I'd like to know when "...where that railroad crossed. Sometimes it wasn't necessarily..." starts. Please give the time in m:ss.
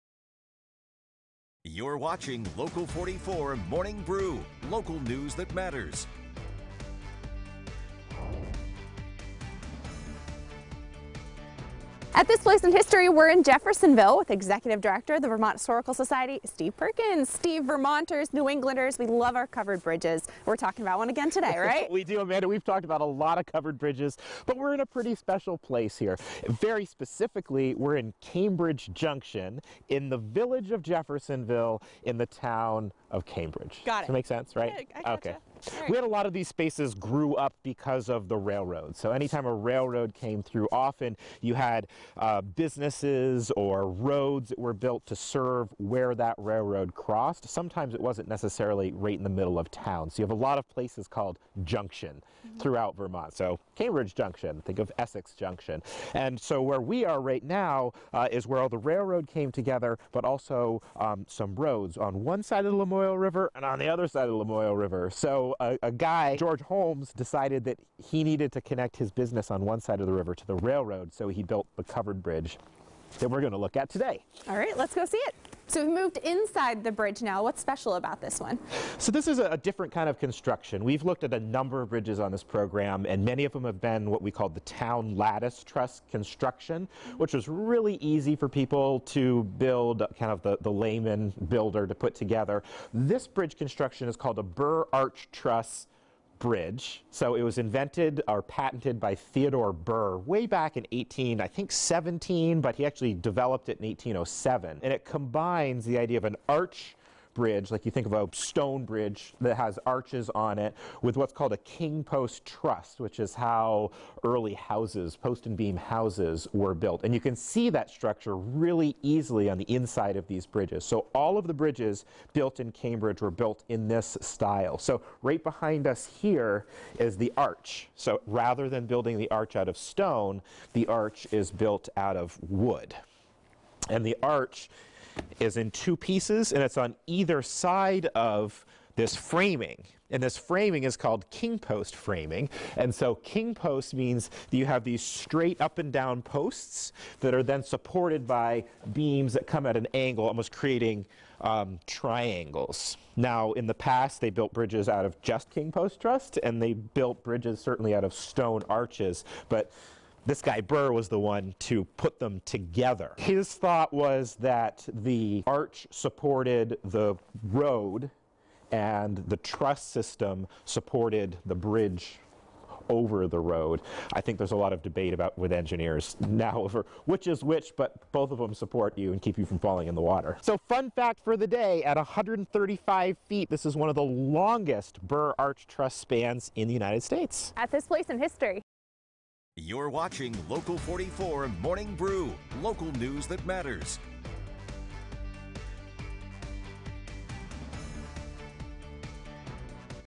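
0:45.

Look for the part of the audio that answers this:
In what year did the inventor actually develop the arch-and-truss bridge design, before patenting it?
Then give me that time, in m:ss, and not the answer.
1:43.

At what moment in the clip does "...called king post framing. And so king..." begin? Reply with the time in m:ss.
2:20.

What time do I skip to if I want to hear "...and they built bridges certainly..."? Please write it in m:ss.
2:36.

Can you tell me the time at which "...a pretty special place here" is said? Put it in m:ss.
0:24.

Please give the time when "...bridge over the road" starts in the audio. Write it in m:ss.
2:51.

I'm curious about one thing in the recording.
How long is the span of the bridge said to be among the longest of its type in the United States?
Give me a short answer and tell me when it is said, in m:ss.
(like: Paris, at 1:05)
135 feet, at 3:01.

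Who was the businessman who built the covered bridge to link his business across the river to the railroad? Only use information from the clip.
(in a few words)
George Holmes.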